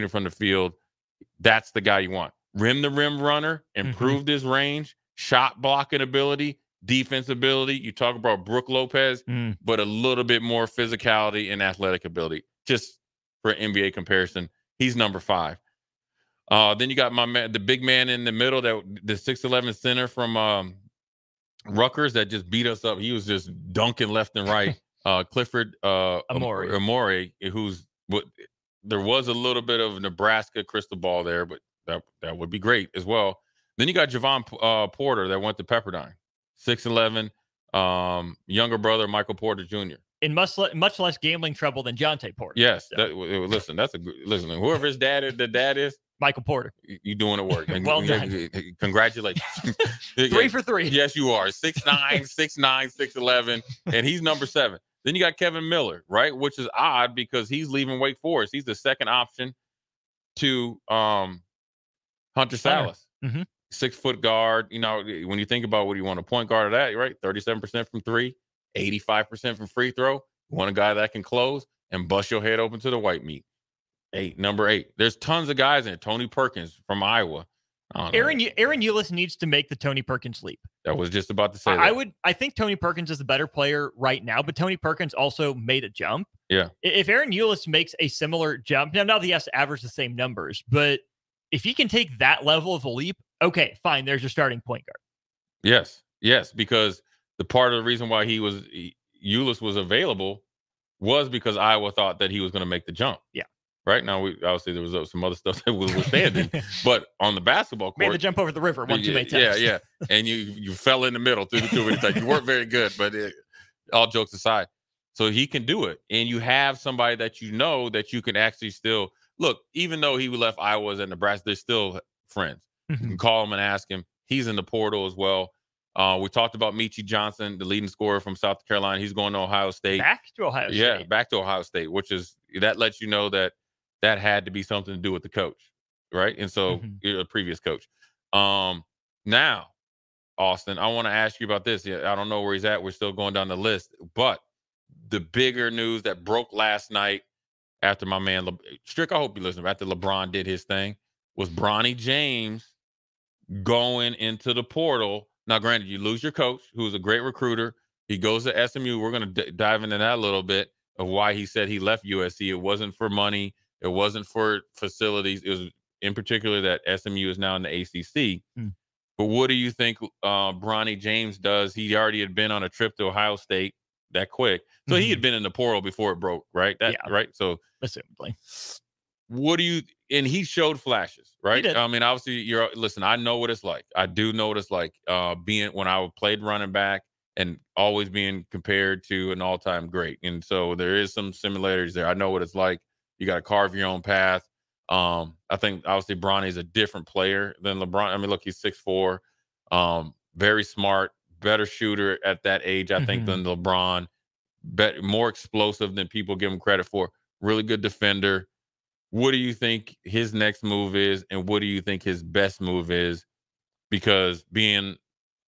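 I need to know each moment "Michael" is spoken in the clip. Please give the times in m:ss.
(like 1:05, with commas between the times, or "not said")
0:39, 0:46.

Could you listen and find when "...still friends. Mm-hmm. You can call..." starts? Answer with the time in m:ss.
2:01.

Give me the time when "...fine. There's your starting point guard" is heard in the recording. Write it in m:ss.
1:33.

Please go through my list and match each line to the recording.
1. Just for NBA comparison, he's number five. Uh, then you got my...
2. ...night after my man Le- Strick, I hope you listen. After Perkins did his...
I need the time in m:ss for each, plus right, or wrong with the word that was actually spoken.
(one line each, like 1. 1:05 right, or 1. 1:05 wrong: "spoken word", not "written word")
1. 0:12 right
2. 2:26 wrong: "LeBron", not "Perkins".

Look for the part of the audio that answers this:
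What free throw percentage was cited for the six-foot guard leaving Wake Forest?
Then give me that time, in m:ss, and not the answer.
1:08.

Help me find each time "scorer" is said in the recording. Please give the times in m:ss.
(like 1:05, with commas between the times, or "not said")
2:07.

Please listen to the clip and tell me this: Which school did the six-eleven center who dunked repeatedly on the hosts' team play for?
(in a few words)
Rutgers.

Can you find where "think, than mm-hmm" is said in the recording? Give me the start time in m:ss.
3:23.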